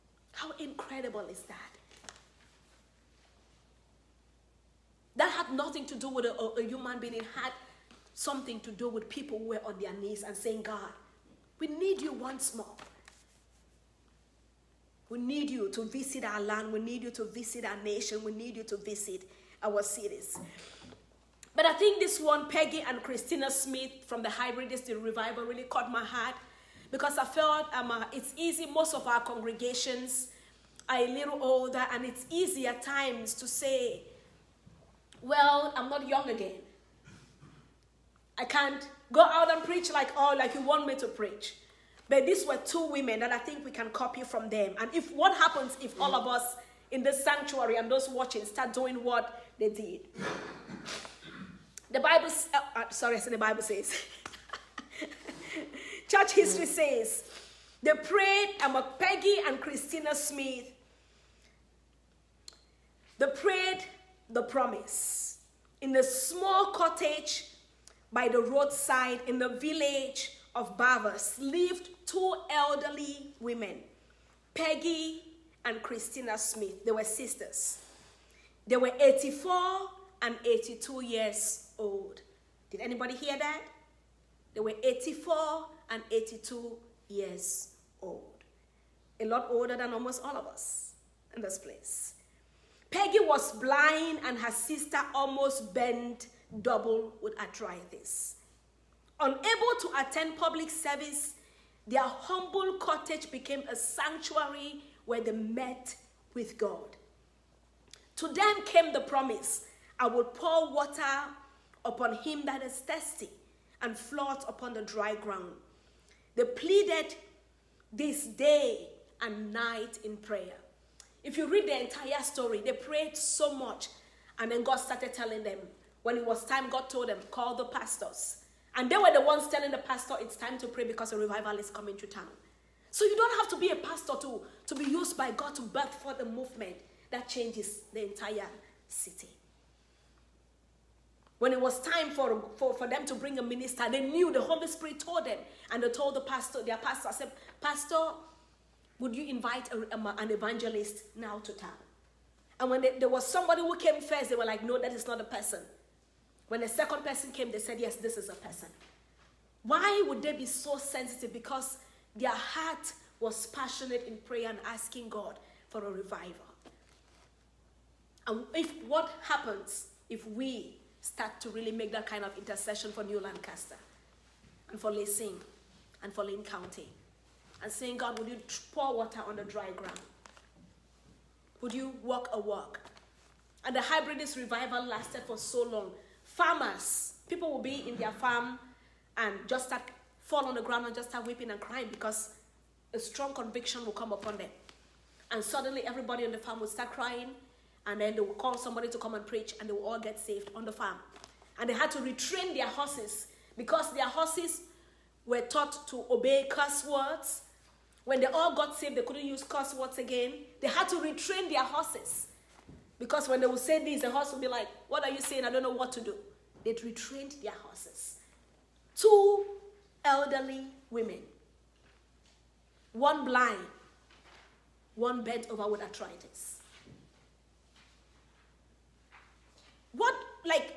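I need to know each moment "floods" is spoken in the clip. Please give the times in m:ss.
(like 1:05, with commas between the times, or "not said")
1:53.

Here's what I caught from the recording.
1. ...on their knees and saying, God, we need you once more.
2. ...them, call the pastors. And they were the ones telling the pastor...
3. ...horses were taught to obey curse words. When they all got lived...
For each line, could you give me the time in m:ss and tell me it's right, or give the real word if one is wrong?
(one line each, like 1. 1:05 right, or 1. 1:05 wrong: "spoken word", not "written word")
1. 0:09 right
2. 2:07 right
3. 3:24 wrong: "saved", not "lived".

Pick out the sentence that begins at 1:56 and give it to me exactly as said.
They pleaded this day and night in prayer.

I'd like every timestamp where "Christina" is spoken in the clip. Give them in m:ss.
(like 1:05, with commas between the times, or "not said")
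0:23, 0:59, 1:15.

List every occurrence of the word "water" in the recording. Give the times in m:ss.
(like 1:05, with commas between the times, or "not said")
1:50, 2:58.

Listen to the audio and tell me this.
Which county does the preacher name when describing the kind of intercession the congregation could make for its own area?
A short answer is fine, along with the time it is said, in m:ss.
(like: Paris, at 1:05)
Lane County, at 2:56.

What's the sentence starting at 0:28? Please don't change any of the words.
Most of our congregations are a little older, and it's easy at times to say, Well, I'm not young again.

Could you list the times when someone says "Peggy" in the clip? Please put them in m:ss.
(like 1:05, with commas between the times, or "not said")
0:22, 0:58, 1:14, 1:32.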